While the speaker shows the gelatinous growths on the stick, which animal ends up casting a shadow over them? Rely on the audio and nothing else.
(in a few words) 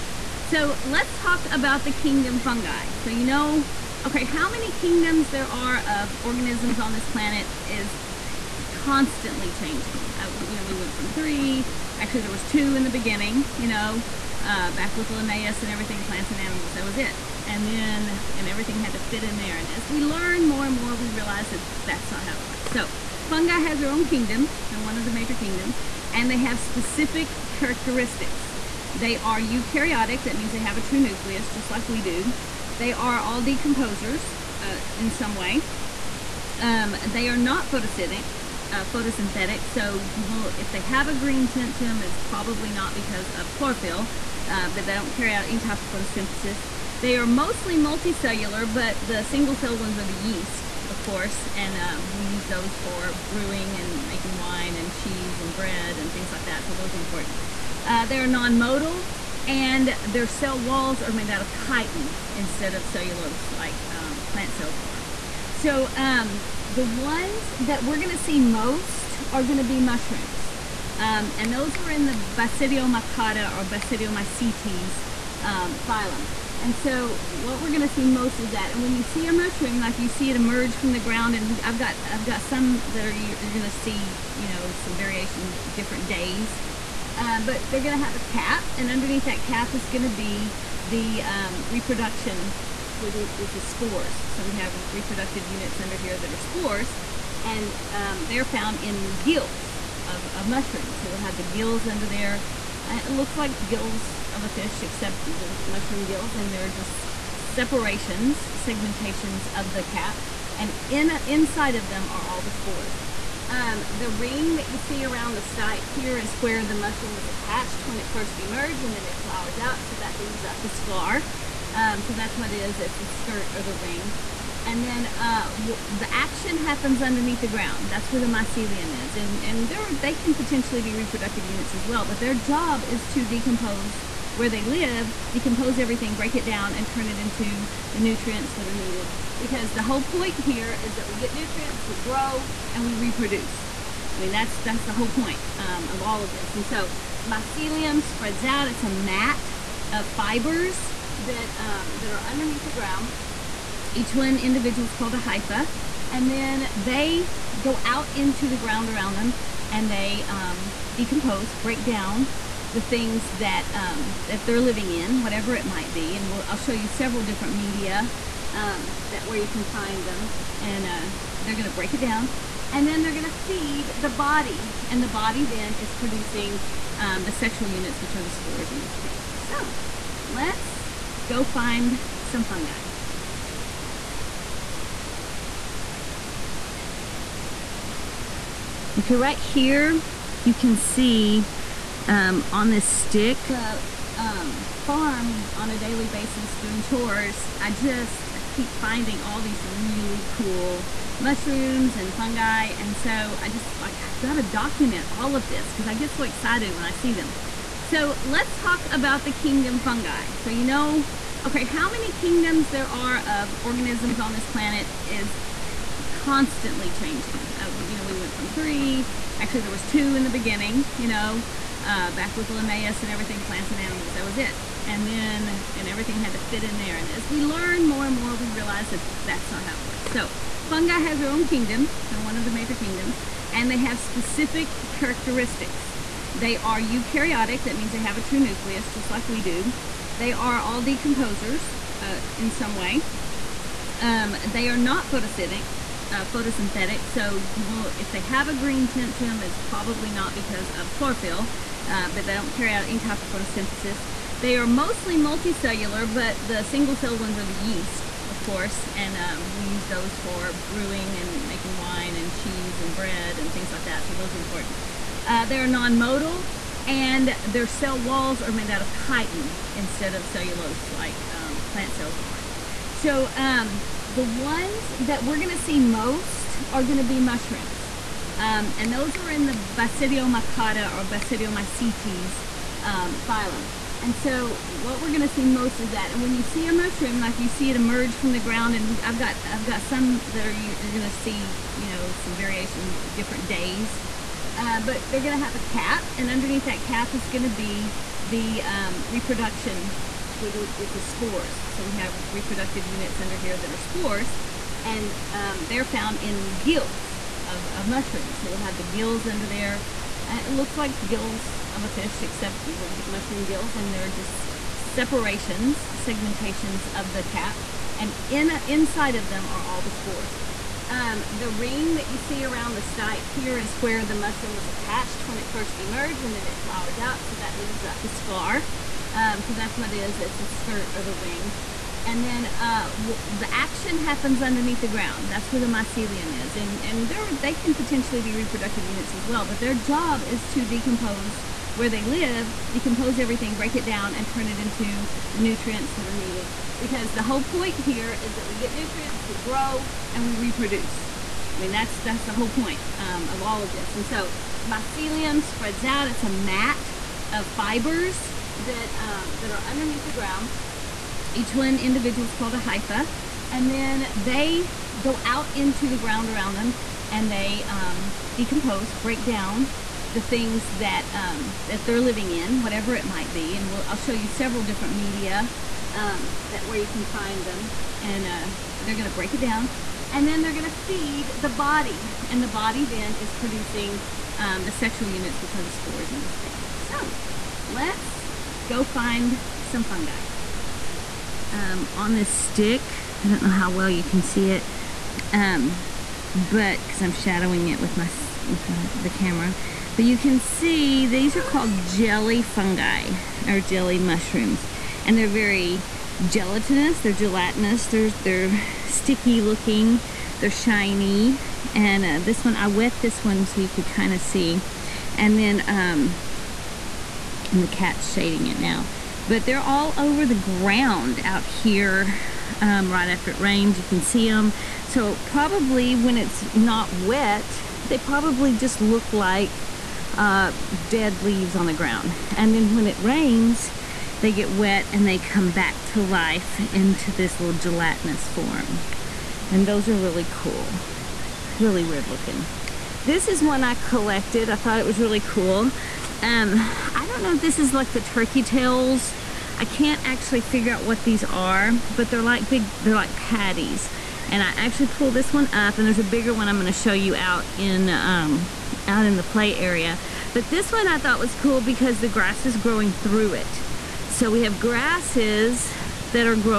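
cat.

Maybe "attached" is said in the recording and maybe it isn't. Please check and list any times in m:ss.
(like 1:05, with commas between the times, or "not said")
1:57, 5:24.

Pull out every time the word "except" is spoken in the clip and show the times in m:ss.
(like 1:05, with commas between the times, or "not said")
1:44, 5:12.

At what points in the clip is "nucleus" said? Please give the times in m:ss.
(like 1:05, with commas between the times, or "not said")
0:30, 3:58.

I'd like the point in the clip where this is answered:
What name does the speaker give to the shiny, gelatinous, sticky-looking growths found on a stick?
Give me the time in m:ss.
6:41.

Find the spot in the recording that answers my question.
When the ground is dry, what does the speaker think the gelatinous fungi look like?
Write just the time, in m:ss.
7:10.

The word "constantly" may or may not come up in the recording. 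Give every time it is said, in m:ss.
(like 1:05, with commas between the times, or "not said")
0:08, 3:36.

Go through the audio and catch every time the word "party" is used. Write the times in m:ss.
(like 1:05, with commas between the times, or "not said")
not said.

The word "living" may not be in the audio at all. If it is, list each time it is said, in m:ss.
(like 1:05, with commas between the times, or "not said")
2:44, 6:12.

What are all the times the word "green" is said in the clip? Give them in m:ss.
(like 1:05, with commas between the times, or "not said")
0:41, 4:08.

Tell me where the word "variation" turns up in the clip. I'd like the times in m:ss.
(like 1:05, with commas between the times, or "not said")
1:24, 4:52.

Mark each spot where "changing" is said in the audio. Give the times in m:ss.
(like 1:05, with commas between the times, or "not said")
0:09, 3:36.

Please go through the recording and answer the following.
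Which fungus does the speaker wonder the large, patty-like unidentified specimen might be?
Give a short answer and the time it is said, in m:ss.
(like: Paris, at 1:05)
turkey tails, at 7:28.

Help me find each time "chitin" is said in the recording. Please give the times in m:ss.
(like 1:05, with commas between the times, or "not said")
1:01, 4:28.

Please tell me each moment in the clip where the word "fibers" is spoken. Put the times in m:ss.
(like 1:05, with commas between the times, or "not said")
2:30, 5:57.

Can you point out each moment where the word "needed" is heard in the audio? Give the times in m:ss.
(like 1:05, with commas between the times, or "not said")
2:18, 5:46.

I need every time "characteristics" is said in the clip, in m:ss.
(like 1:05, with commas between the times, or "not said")
0:27, 3:54.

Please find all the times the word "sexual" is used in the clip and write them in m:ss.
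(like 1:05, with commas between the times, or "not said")
2:57, 6:24.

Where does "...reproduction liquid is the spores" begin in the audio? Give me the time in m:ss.
4:59.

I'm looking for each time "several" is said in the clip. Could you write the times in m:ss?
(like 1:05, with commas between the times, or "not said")
2:46, 6:14.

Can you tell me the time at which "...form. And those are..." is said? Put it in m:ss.
7:18.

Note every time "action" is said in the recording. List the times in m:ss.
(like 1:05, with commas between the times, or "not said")
2:06, 5:33.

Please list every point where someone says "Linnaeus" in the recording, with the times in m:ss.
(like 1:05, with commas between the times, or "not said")
0:15, 3:42.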